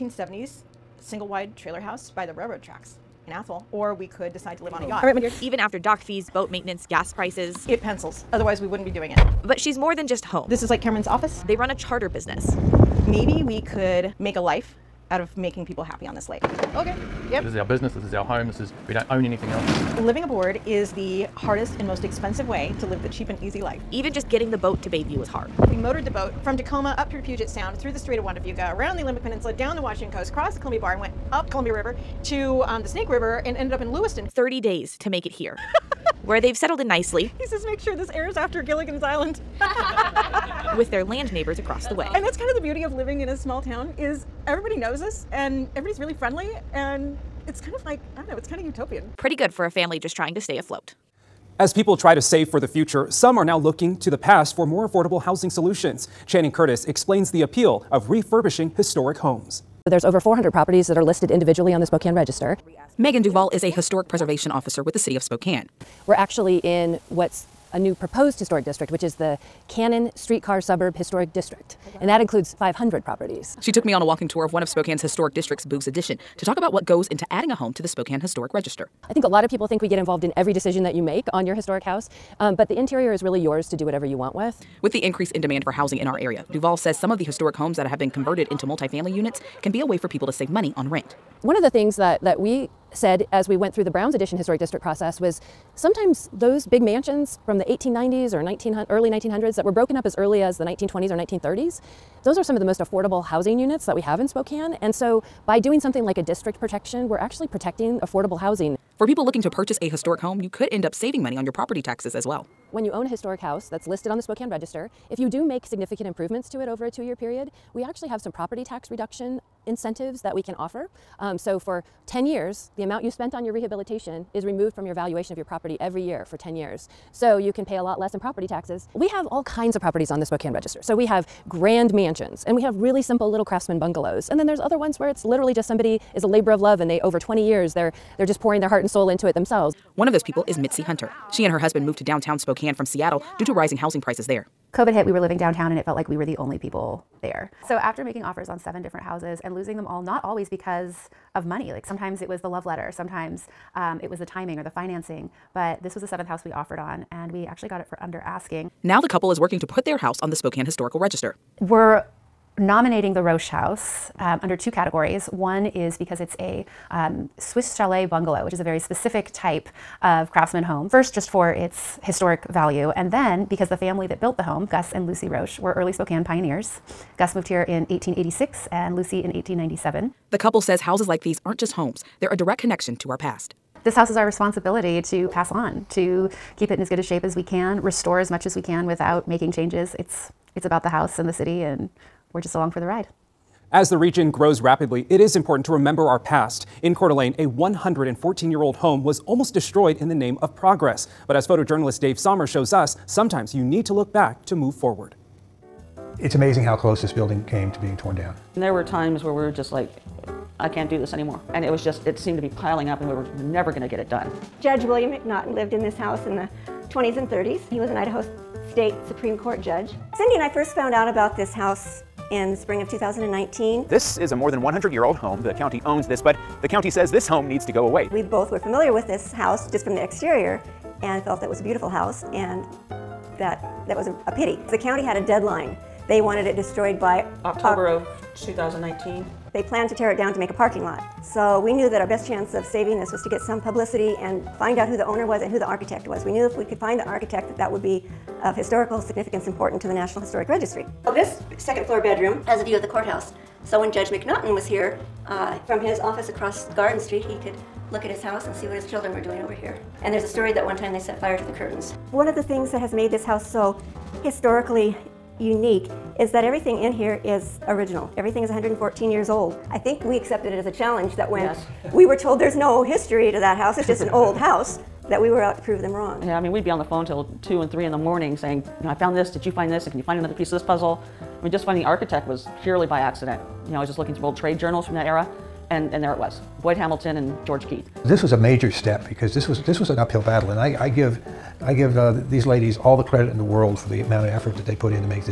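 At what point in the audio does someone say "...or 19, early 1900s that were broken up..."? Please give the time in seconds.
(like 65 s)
98 s.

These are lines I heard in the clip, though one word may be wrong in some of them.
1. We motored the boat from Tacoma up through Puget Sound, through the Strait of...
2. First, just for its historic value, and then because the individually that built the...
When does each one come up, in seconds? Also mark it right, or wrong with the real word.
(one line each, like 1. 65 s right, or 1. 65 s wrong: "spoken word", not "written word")
1. 25 s right
2. 170 s wrong: "family", not "individually".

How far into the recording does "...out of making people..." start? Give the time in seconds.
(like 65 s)
15 s.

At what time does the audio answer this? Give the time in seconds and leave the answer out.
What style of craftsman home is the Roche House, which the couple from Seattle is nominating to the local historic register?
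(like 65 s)
167 s.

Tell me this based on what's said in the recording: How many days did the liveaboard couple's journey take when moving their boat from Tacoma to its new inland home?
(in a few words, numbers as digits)
30 days.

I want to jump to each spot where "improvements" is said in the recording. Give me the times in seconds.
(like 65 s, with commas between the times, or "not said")
116 s.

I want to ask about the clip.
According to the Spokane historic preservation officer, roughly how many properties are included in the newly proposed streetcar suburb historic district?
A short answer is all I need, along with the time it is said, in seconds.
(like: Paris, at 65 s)
500, at 72 s.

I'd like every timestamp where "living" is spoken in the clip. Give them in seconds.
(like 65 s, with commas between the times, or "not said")
19 s, 42 s, 145 s.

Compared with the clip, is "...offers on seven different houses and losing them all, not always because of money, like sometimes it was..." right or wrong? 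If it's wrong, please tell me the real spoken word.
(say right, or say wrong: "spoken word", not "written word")
right.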